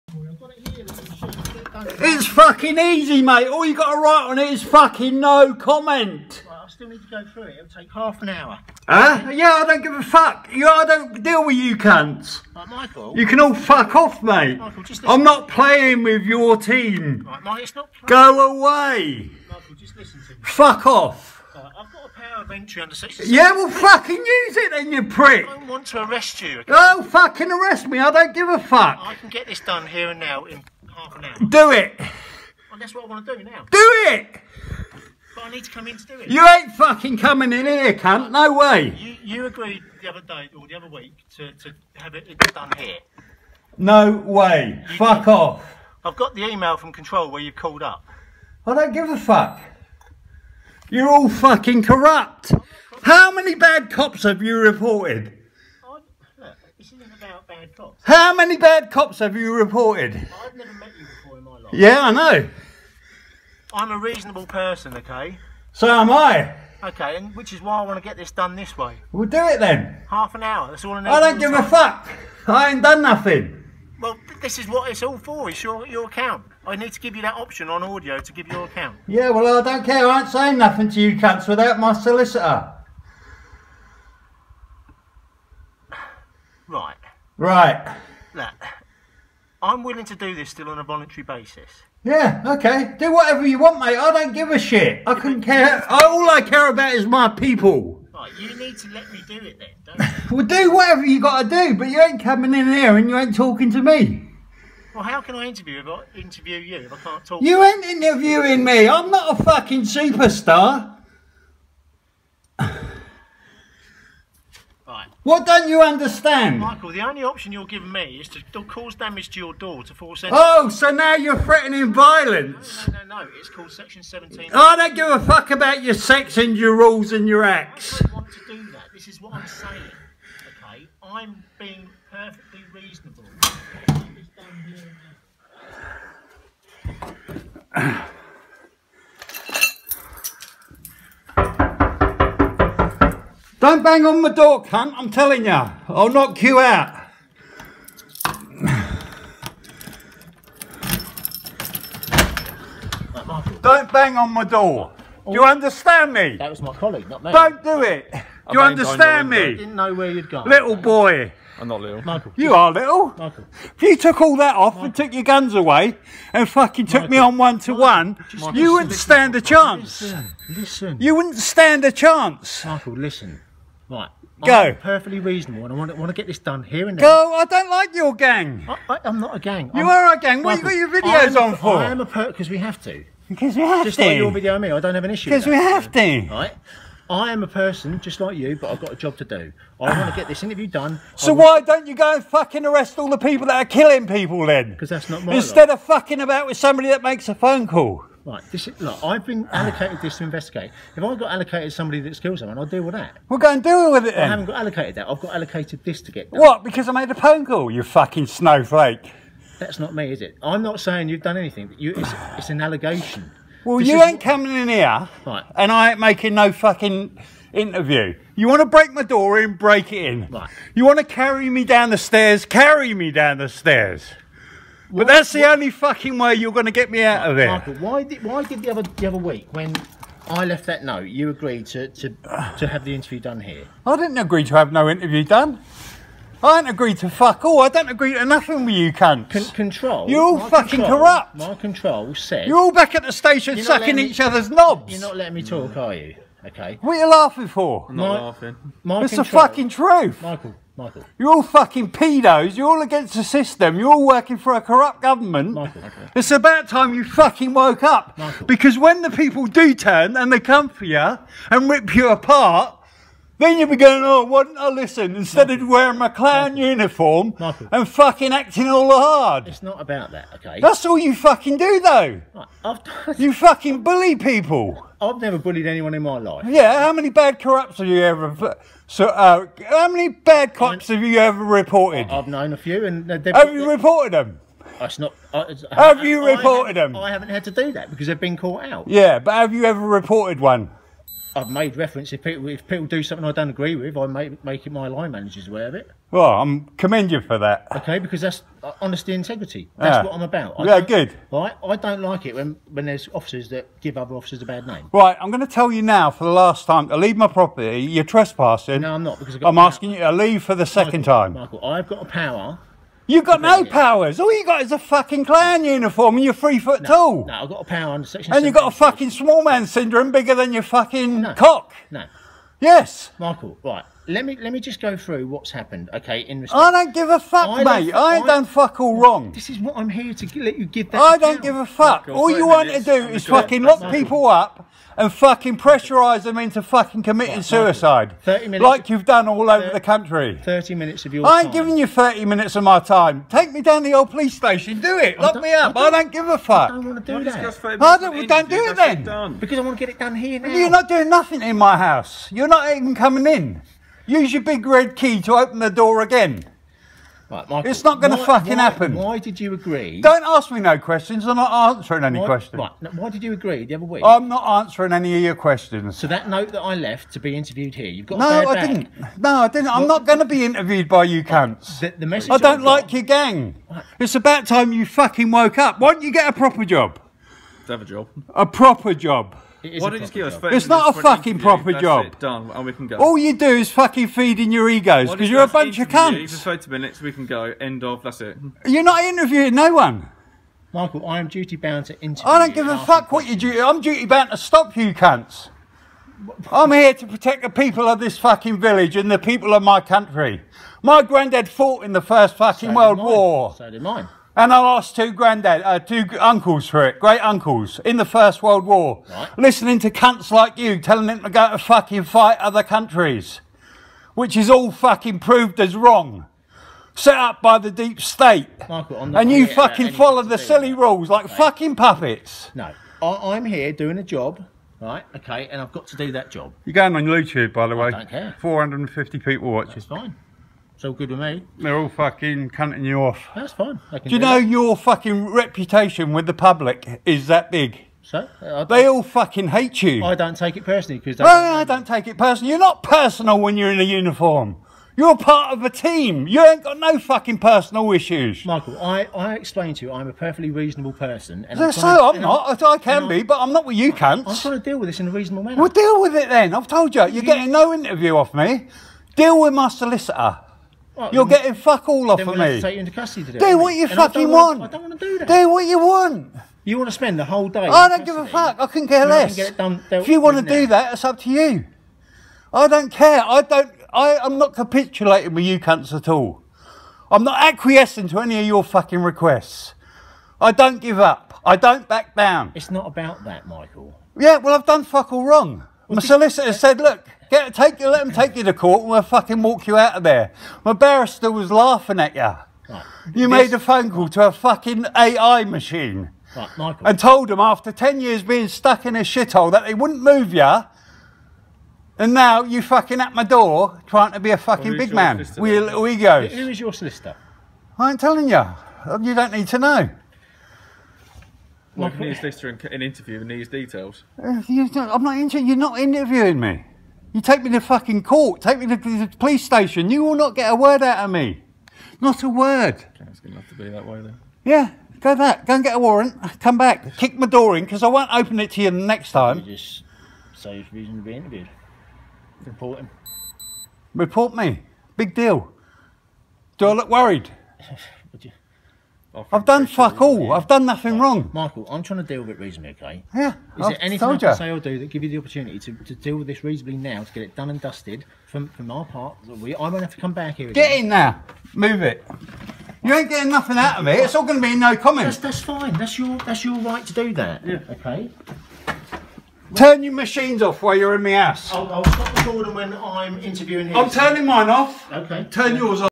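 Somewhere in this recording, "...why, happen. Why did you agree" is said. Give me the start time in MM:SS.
05:58.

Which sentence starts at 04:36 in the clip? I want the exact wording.
Yeah, how many bad corrupts have you ever...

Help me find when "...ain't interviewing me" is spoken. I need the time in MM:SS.
01:47.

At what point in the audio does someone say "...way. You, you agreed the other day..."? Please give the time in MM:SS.
00:38.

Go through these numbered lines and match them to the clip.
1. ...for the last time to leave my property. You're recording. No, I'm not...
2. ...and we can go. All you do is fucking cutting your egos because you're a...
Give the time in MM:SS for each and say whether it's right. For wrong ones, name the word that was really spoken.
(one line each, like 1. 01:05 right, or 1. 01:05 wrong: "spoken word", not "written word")
1. 05:06 wrong: "trespassing", not "recording"
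2. 06:22 wrong: "feeding", not "cutting".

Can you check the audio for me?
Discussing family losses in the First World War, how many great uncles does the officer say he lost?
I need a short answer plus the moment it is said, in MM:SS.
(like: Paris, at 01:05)
2, at 06:45.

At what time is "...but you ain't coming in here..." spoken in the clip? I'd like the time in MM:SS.
01:41.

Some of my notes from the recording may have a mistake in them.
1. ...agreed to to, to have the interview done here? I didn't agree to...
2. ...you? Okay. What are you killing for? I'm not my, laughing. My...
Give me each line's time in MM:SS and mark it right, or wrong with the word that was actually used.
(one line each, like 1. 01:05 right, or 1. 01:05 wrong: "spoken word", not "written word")
1. 03:51 right
2. 04:05 wrong: "laughing", not "killing".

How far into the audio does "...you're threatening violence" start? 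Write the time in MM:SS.
02:01.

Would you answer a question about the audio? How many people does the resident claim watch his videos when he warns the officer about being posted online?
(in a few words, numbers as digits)
450.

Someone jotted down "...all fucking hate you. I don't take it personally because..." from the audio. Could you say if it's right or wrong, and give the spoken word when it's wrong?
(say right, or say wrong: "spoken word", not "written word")
right.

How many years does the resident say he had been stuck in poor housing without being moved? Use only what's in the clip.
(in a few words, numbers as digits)
10.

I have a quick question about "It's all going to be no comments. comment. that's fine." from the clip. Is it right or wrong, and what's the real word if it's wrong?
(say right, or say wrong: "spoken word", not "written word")
right.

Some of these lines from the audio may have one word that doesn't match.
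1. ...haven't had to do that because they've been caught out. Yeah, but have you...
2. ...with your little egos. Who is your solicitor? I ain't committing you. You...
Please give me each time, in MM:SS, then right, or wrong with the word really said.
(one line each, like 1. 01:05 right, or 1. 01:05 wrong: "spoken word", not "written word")
1. 04:47 right
2. 08:25 wrong: "telling", not "committing".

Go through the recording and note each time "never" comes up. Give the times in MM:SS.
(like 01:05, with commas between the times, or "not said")
01:00, 04:35.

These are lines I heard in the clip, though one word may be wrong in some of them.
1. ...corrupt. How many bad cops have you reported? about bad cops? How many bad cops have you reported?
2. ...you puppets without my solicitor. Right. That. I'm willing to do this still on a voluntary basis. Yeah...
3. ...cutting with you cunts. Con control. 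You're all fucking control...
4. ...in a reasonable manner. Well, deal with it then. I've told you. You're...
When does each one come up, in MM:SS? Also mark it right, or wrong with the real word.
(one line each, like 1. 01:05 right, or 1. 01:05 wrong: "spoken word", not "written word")
1. 00:51 right
2. 01:20 wrong: "cunts", not "puppets"
3. 03:58 wrong: "nothing", not "cutting"
4. 07:34 right.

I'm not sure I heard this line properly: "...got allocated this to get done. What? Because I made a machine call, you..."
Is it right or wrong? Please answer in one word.
wrong.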